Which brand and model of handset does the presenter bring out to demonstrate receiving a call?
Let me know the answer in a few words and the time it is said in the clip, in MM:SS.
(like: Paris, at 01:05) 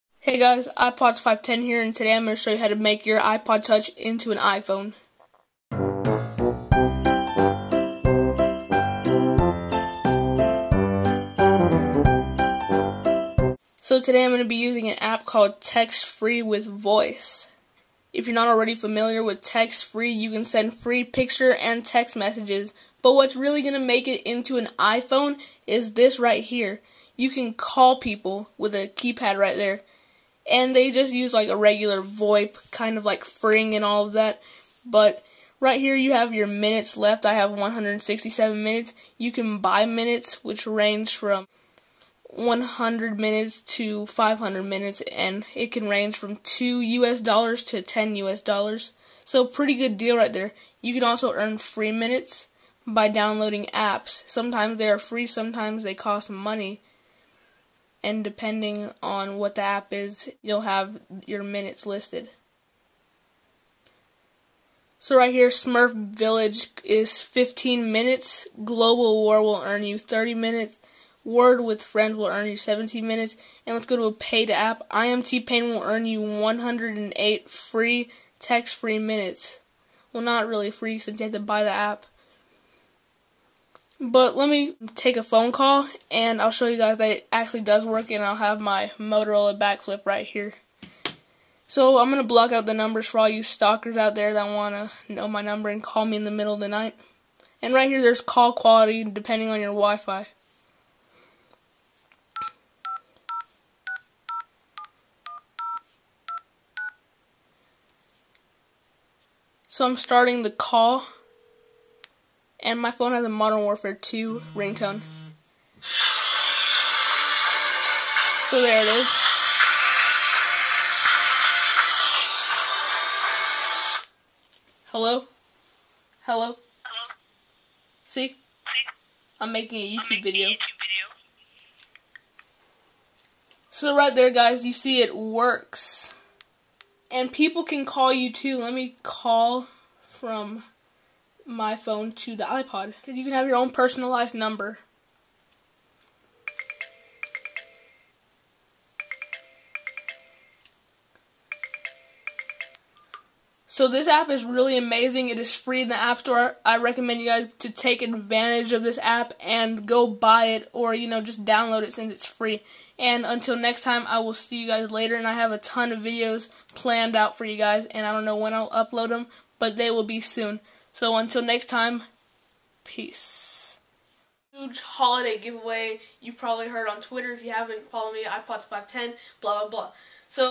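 Motorola Backflip, at 01:28.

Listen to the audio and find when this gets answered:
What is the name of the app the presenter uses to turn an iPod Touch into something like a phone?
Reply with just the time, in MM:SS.
00:15.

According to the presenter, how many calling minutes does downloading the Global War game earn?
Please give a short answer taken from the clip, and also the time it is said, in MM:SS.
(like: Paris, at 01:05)
30 minutes, at 01:09.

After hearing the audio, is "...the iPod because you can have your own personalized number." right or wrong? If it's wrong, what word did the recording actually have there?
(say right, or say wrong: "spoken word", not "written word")
right.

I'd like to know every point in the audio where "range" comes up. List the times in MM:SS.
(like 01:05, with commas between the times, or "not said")
00:40, 00:45.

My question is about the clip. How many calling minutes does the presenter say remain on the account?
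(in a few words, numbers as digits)
167.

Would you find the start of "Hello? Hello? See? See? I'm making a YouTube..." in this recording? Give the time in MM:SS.
02:05.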